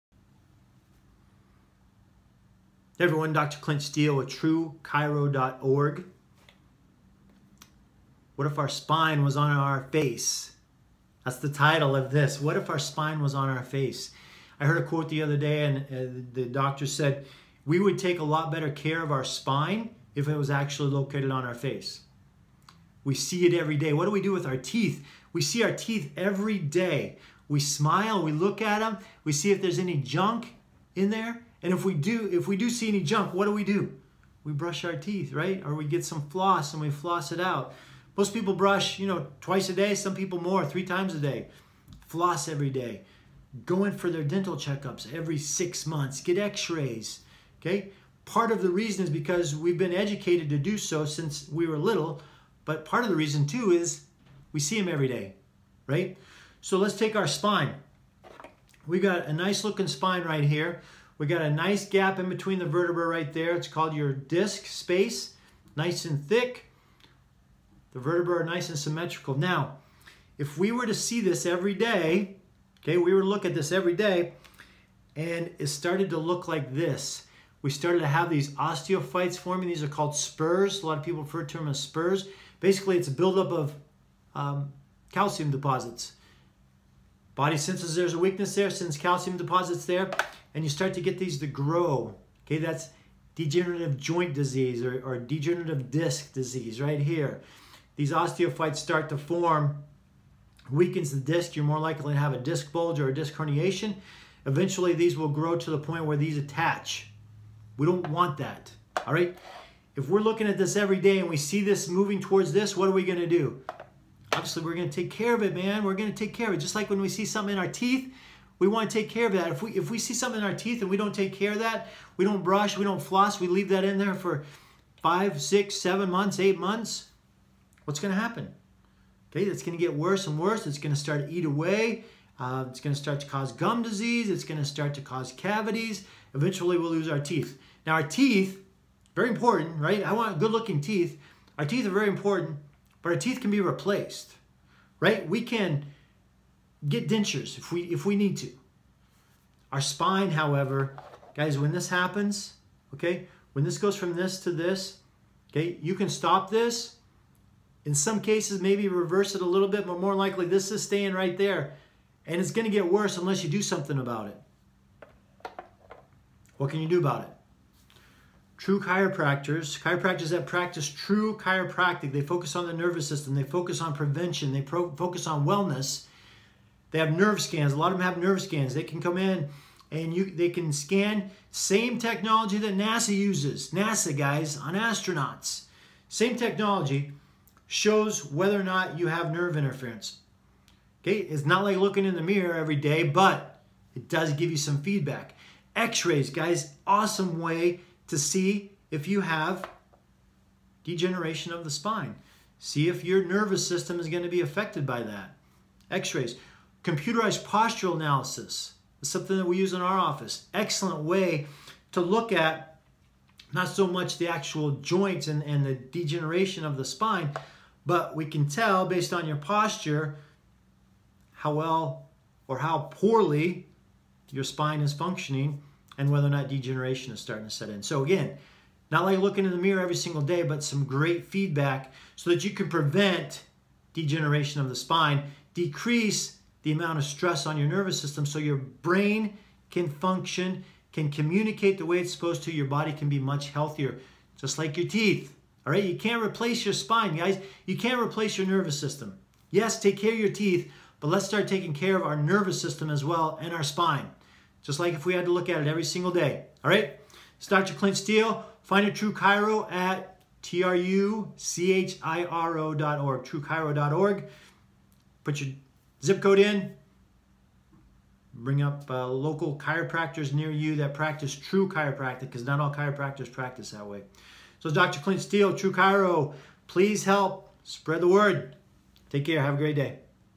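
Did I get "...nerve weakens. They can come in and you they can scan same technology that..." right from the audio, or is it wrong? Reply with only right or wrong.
wrong.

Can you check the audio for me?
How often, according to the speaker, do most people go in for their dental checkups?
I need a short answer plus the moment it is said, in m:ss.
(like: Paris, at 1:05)
every 6 months, at 0:45.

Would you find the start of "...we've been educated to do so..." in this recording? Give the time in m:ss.
0:49.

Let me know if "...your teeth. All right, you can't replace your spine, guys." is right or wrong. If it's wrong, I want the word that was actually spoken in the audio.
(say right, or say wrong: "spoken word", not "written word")
right.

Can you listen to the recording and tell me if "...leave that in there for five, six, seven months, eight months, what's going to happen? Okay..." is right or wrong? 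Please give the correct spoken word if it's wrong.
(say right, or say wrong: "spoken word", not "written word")
right.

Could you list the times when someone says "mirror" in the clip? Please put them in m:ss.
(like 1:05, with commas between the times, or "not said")
3:12, 3:49.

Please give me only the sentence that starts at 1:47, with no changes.
We don't want that, all right?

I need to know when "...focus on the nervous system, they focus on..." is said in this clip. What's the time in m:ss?
2:52.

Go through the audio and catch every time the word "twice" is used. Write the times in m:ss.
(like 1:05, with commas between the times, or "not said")
0:39.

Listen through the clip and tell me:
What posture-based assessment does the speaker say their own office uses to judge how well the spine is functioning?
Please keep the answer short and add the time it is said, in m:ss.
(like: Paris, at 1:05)
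Computerized postural analysis, at 3:26.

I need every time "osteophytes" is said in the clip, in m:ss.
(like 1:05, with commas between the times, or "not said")
1:18, 1:38.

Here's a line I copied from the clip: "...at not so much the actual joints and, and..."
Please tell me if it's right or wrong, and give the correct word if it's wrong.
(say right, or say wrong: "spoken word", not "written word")
right.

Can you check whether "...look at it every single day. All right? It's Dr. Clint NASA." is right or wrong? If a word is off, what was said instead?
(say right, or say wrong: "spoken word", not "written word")
wrong: "Steele", not "NASA".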